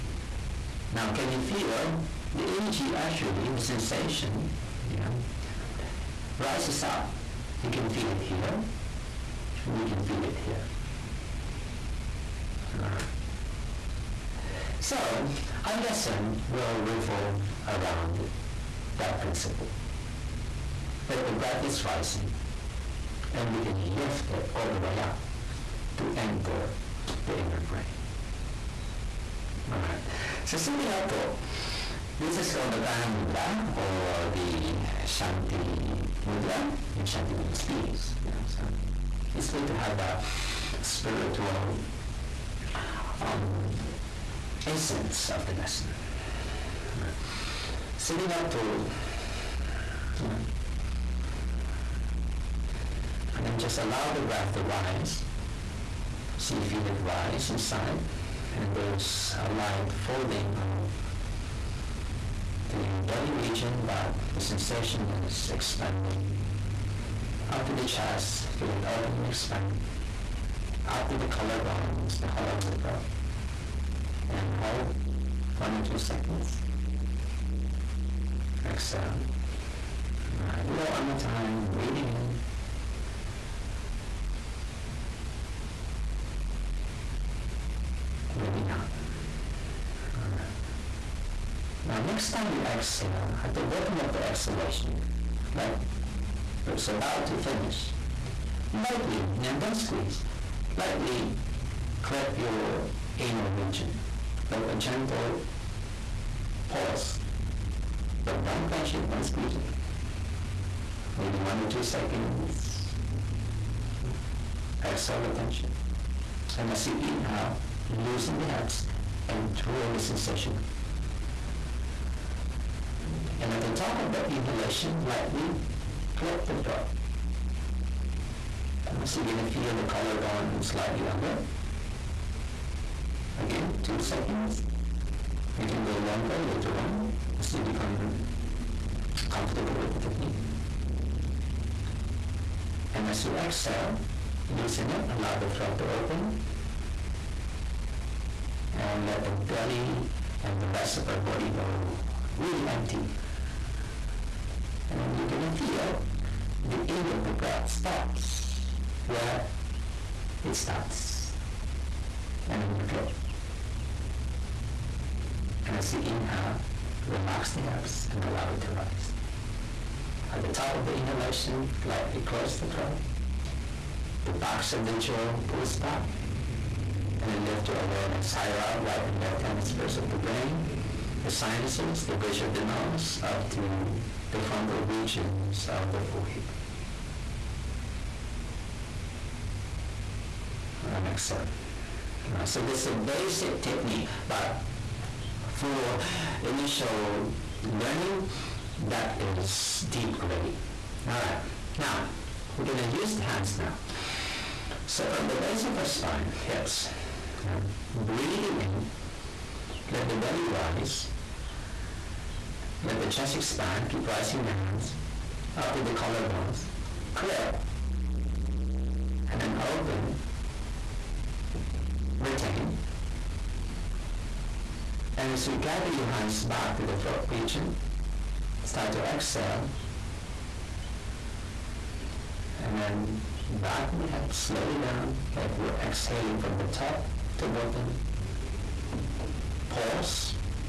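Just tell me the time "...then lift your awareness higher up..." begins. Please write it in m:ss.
2:57.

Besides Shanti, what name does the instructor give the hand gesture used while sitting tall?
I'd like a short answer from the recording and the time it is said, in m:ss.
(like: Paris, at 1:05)
Prana Mudra, at 0:32.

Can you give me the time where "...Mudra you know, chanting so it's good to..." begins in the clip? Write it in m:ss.
0:36.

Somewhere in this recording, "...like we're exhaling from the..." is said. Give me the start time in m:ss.
3:55.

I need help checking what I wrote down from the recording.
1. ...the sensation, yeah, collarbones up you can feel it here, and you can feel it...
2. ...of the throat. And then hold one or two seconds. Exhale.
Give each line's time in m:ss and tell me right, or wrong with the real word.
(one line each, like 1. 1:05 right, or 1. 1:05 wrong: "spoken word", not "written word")
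1. 0:03 wrong: "rises", not "collarbones"
2. 1:12 right.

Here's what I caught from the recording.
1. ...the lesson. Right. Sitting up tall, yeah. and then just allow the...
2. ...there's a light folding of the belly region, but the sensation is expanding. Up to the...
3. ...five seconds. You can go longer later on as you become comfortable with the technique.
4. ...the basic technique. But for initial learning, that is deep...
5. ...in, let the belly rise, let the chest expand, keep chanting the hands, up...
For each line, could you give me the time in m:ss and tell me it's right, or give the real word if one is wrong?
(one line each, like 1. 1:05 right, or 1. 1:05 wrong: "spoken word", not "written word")
1. 0:45 right
2. 0:58 right
3. 2:13 wrong: "two", not "five"
4. 3:12 right
5. 3:28 wrong: "rising", not "chanting".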